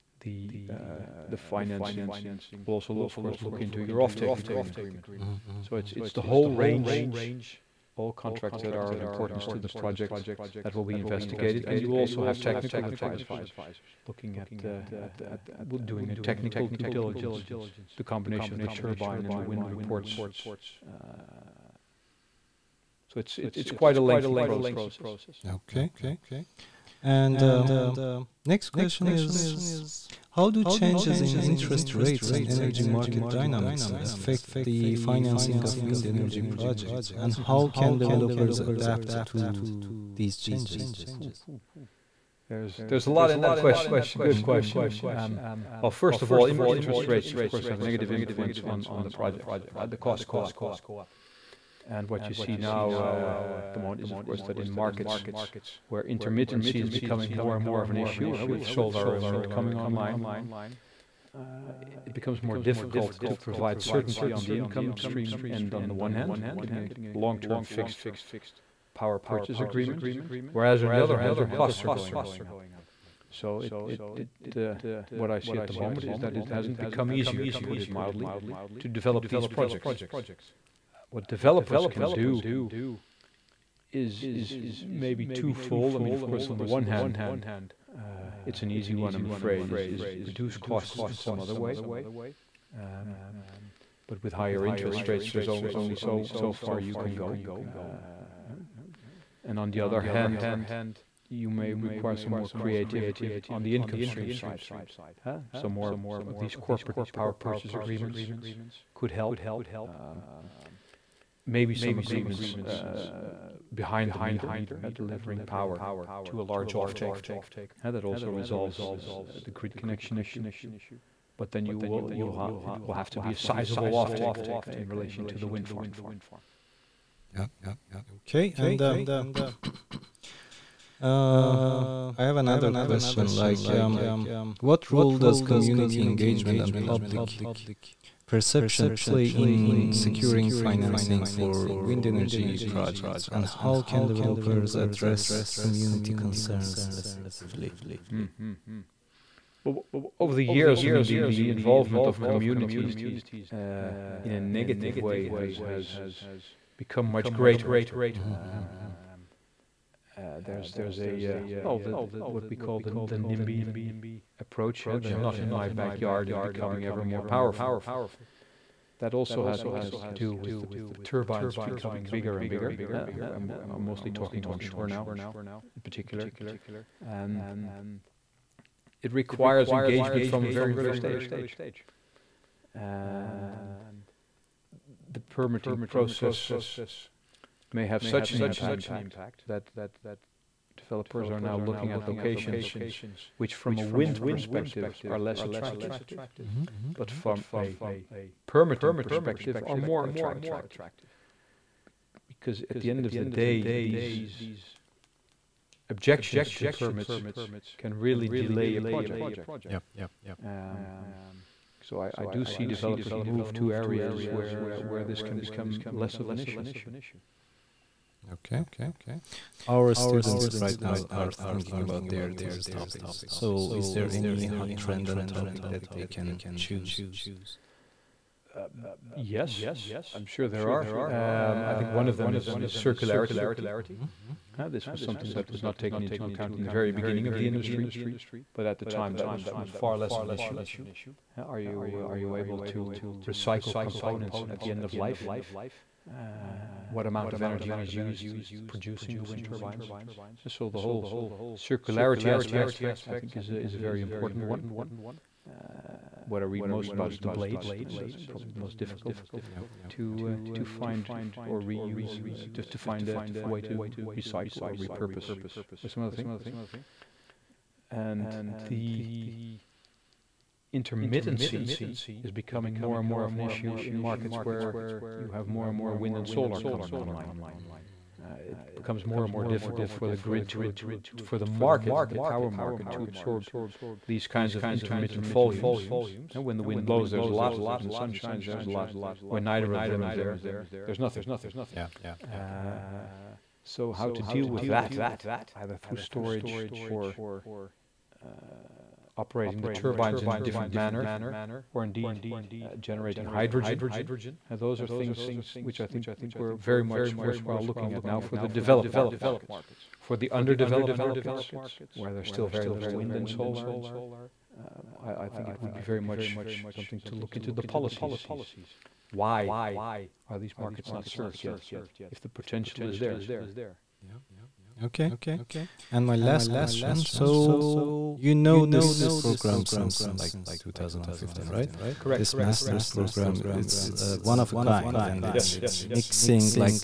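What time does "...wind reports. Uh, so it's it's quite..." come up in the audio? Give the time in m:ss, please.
0:19.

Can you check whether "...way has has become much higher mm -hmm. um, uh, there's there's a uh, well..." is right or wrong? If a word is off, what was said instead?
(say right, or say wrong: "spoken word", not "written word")
wrong: "greater", not "higher".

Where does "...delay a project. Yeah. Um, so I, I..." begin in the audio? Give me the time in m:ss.
3:28.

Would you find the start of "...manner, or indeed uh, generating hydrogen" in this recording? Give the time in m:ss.
5:00.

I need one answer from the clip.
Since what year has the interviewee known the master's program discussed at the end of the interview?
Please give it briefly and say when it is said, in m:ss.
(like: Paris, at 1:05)
2015, at 5:30.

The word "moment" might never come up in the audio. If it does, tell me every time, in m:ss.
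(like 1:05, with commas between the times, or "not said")
0:53, 1:15.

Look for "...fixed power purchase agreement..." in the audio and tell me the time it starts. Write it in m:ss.
1:07.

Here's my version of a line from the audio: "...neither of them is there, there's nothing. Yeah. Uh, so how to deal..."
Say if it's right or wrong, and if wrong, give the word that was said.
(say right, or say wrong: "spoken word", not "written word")
right.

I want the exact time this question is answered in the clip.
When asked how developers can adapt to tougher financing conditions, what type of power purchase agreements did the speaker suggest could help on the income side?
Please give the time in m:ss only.
1:46.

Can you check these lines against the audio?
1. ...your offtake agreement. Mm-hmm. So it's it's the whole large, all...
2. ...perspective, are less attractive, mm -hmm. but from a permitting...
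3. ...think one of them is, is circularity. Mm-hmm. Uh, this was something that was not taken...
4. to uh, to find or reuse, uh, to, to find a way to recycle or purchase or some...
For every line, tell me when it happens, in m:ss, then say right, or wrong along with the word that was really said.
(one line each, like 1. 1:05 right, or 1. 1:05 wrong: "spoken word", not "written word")
1. 0:03 wrong: "range", not "large"
2. 3:14 right
3. 3:51 right
4. 4:19 wrong: "repurpose", not "purchase".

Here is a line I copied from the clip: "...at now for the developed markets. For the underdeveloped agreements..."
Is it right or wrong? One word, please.
wrong.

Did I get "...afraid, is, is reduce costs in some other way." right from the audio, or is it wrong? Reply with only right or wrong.
right.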